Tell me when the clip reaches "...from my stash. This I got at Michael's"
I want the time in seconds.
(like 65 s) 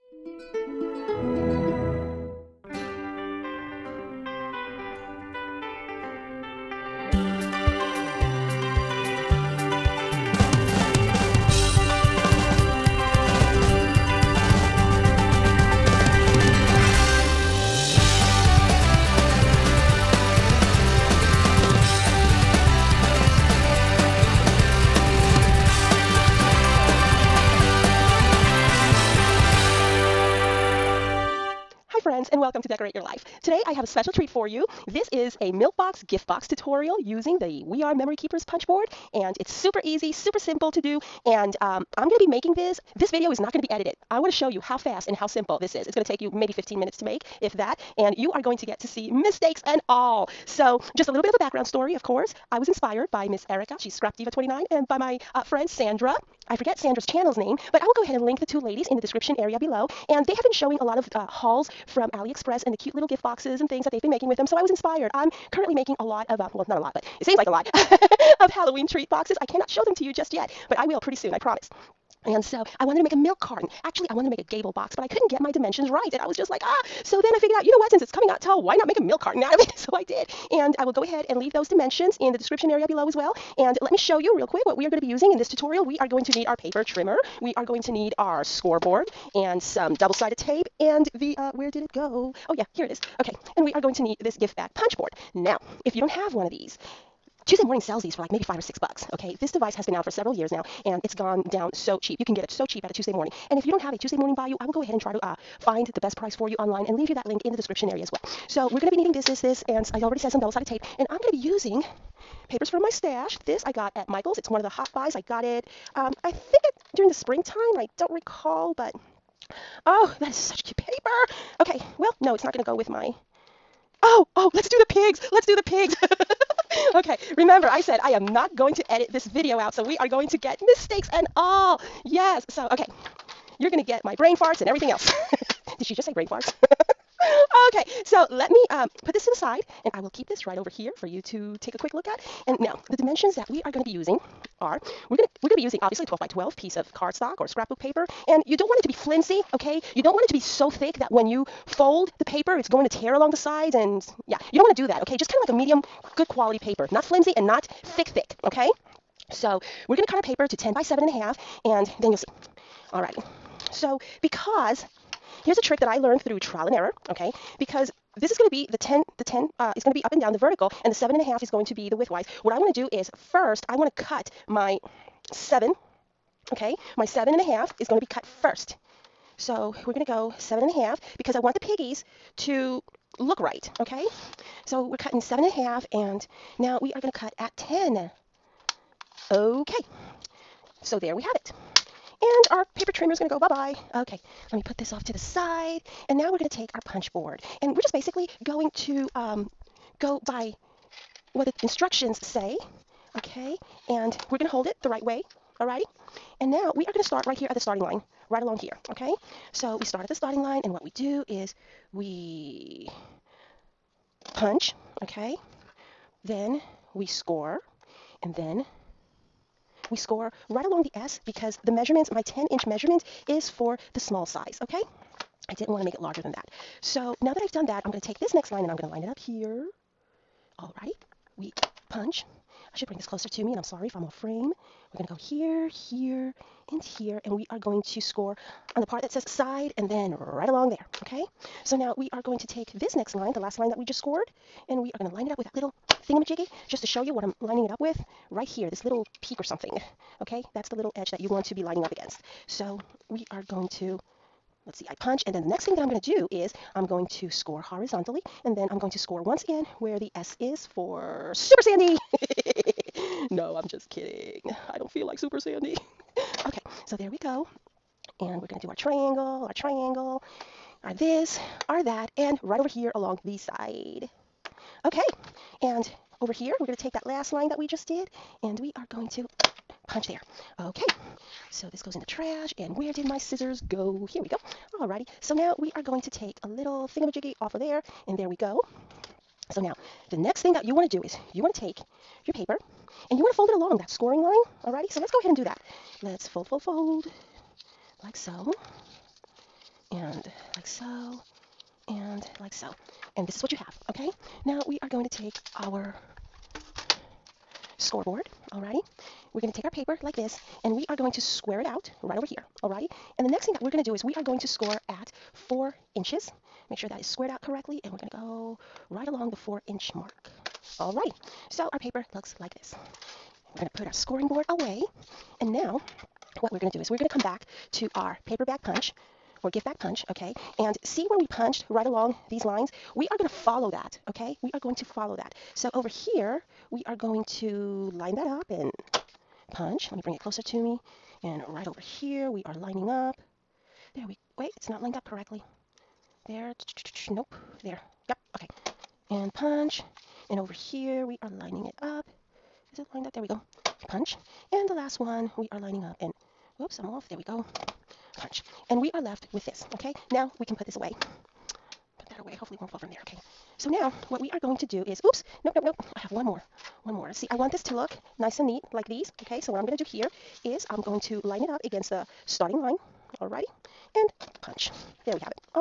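112 s.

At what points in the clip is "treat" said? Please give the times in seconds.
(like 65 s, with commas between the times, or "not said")
34 s, 68 s.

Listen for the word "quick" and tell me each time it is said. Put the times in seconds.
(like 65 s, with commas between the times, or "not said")
84 s, 141 s.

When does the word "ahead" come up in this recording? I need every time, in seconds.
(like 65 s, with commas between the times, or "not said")
58 s, 81 s, 104 s, 295 s.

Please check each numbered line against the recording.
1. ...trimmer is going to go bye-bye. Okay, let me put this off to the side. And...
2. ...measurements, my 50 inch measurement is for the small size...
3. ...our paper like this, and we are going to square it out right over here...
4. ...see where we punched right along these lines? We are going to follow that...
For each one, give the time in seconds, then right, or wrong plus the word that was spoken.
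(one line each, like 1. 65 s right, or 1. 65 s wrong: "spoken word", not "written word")
1. 192 s right
2. 221 s wrong: "10", not "50"
3. 309 s right
4. 330 s right.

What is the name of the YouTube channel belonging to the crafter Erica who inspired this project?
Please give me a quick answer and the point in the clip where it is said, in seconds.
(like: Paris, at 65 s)
Scrap Diva 29, at 53 s.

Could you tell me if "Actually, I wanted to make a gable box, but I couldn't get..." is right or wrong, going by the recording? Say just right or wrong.
right.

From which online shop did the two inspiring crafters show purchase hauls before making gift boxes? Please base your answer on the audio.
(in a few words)
AliExpress.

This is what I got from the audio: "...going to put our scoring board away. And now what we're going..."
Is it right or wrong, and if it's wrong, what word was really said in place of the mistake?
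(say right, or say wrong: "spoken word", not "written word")
right.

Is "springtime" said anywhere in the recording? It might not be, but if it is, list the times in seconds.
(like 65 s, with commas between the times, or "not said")
117 s.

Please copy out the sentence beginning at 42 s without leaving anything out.
This video is not going to be edited.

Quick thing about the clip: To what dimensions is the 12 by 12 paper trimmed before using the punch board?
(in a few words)
10 by 7.5.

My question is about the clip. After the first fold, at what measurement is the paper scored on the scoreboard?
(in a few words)
4 inches.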